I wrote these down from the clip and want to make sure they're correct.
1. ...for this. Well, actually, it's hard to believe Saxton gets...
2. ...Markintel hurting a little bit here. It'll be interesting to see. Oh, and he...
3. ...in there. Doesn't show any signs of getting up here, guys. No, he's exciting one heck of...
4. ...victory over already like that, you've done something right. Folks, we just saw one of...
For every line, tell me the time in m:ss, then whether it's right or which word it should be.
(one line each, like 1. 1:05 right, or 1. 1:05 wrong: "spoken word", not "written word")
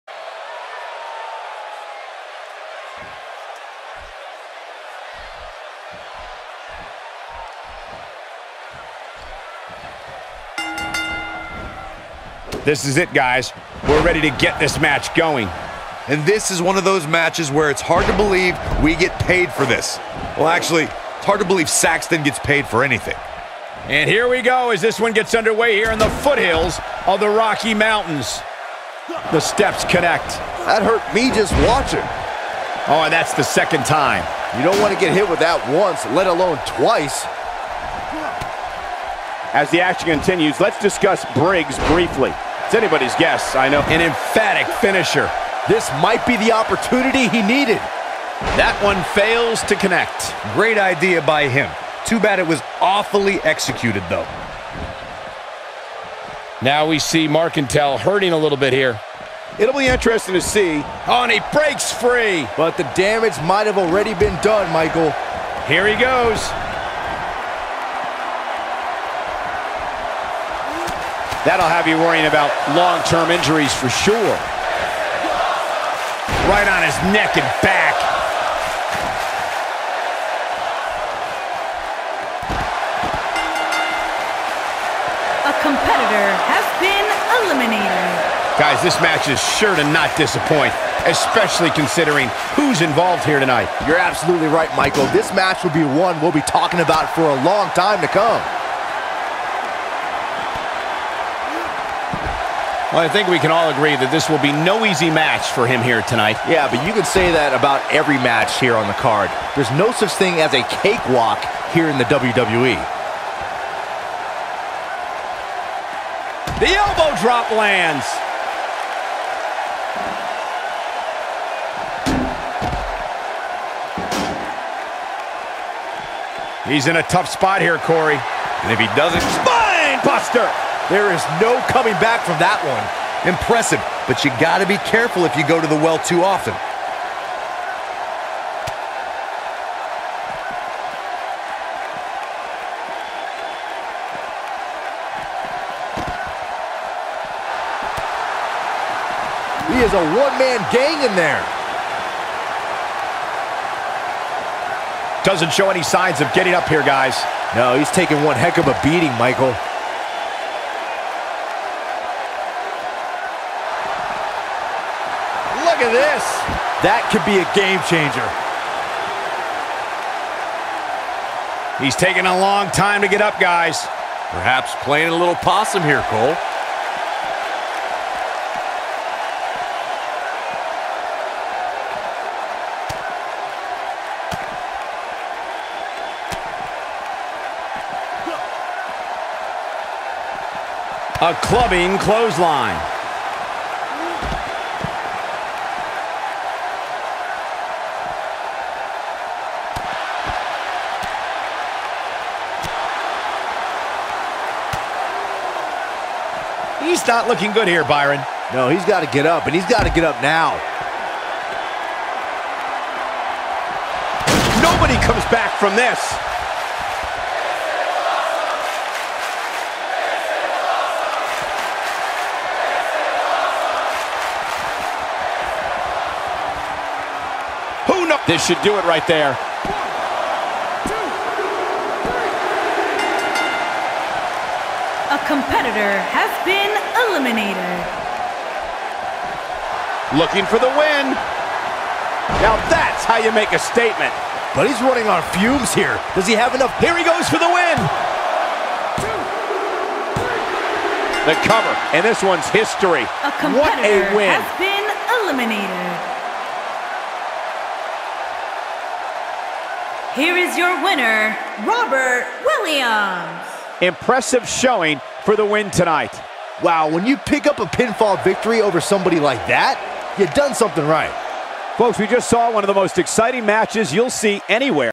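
1. 0:19 right
2. 0:57 right
3. 2:31 wrong: "taking", not "exciting"
4. 4:28 wrong: "somebody", not "already".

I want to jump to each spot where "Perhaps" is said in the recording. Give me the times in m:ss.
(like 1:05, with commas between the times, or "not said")
2:54.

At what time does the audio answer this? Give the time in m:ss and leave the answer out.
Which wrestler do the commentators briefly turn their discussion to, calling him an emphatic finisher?
0:41.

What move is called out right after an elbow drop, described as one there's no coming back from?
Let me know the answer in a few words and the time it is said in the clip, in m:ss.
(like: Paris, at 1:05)
Spine buster, at 2:09.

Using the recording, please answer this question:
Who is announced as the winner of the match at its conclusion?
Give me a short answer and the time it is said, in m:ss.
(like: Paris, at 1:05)
Robert Williams, at 4:21.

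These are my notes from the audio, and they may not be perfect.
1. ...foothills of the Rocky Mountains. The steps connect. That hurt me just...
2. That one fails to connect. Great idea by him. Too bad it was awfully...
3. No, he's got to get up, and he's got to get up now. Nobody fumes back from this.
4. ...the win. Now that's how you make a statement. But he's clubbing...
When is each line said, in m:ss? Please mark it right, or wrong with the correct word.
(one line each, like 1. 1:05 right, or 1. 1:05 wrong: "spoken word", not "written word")
1. 0:26 right
2. 0:48 right
3. 3:28 wrong: "comes", not "fumes"
4. 4:00 wrong: "running", not "clubbing".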